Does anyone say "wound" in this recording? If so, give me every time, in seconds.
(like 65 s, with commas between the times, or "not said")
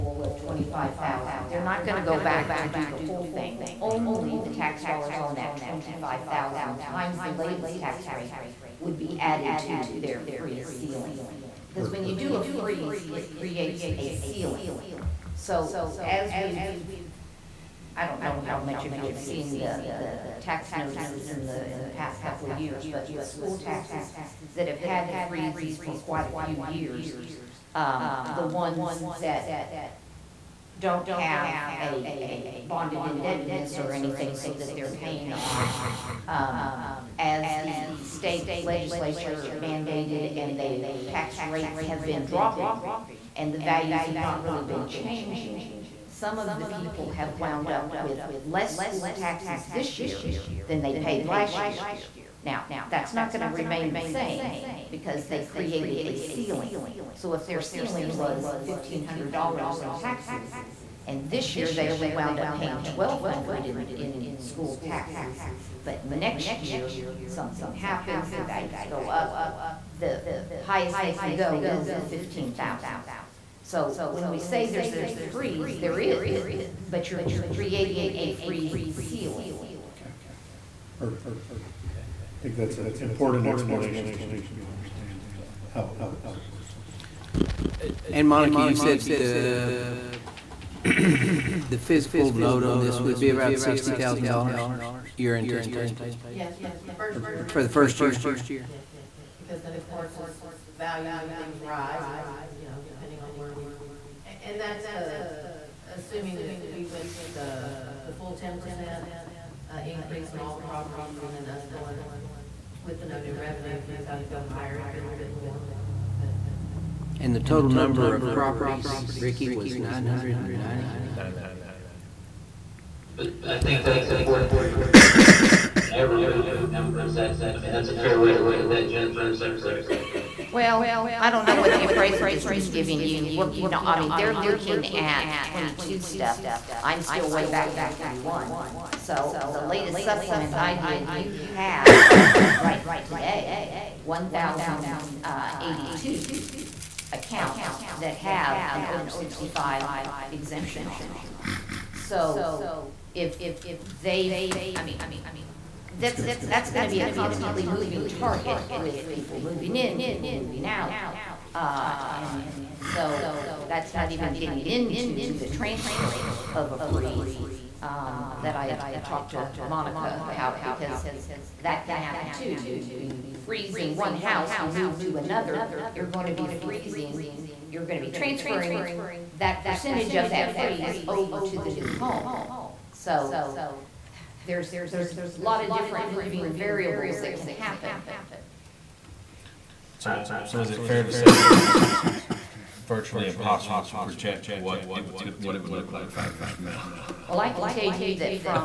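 47 s, 62 s.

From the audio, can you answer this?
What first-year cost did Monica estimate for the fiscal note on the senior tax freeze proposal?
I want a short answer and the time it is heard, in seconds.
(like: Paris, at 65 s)
$60,000, at 93 s.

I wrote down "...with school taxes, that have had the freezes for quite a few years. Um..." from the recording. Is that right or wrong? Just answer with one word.
right.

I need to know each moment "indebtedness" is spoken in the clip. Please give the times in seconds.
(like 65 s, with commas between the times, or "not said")
33 s.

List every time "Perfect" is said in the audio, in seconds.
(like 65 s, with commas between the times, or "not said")
80 s.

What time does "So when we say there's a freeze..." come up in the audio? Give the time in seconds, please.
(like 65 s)
73 s.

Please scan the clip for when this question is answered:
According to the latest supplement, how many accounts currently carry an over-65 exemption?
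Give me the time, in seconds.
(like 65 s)
144 s.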